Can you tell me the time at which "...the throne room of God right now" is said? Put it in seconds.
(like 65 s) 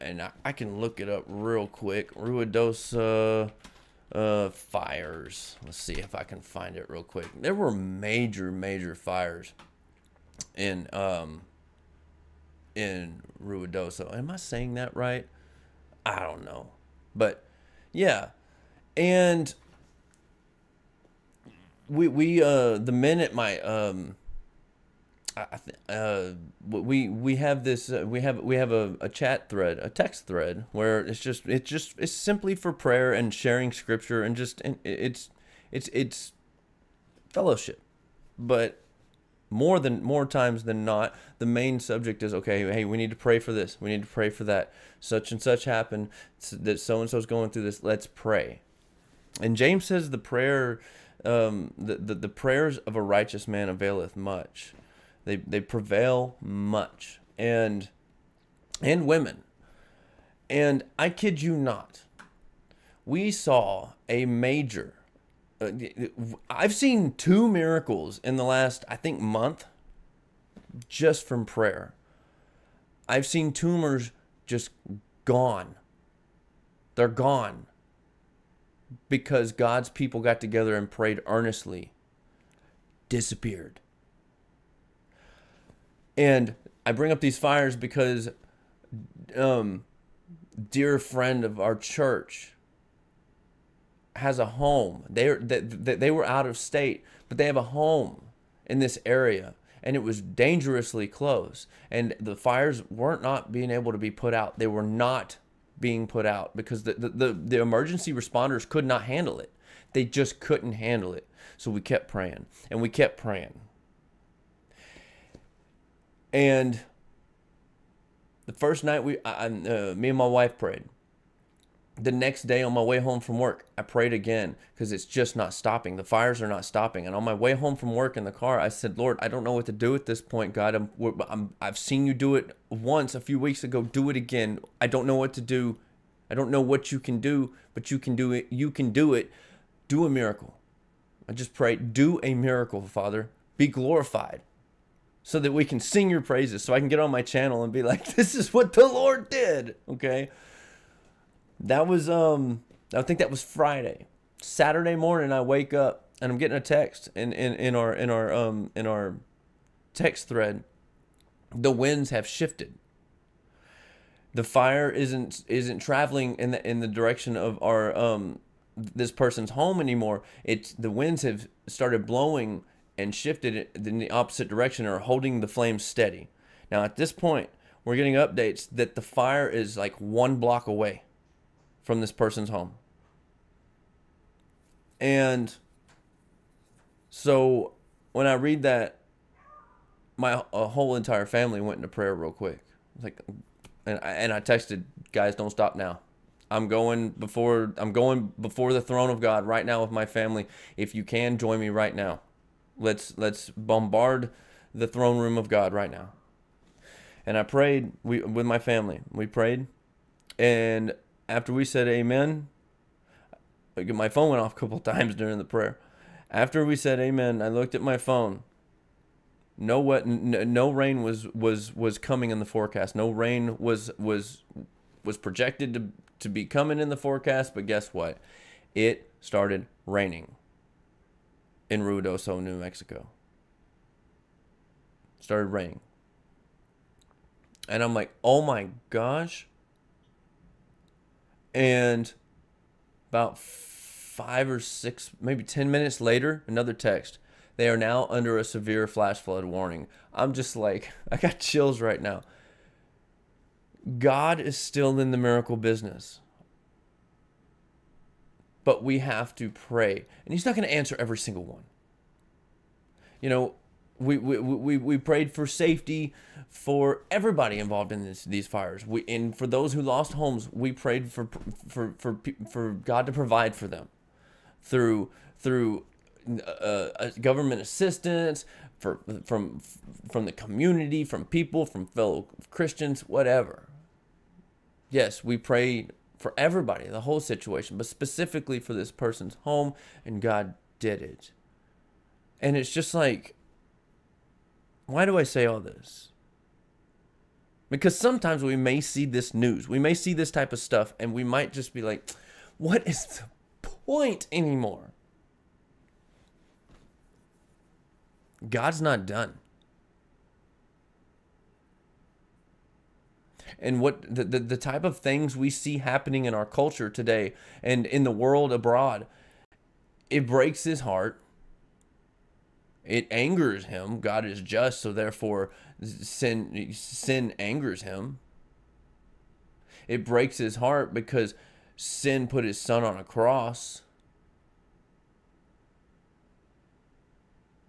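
204 s.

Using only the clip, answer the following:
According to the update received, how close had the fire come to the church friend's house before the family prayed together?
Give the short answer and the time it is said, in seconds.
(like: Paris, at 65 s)
One block, at 180 s.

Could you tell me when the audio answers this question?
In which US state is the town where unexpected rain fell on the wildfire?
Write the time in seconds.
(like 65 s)
232 s.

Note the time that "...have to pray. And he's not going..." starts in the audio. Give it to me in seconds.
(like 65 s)
258 s.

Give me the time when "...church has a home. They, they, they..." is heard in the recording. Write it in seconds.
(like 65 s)
91 s.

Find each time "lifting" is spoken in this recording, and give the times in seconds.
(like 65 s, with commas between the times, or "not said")
not said.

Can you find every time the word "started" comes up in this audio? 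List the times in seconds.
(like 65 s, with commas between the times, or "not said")
171 s, 229 s, 235 s.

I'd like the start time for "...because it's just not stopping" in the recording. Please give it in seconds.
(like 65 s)
124 s.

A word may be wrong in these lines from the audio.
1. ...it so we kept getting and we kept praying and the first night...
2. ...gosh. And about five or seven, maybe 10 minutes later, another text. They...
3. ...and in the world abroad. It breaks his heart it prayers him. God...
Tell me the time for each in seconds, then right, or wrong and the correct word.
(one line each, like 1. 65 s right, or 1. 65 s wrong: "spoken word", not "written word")
1. 111 s wrong: "praying", not "getting"
2. 238 s wrong: "six", not "seven"
3. 317 s wrong: "angers", not "prayers".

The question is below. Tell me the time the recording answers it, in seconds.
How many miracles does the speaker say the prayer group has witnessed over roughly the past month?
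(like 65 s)
67 s.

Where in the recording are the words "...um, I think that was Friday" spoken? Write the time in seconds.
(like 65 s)
152 s.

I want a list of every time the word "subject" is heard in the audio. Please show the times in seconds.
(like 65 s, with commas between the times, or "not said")
41 s.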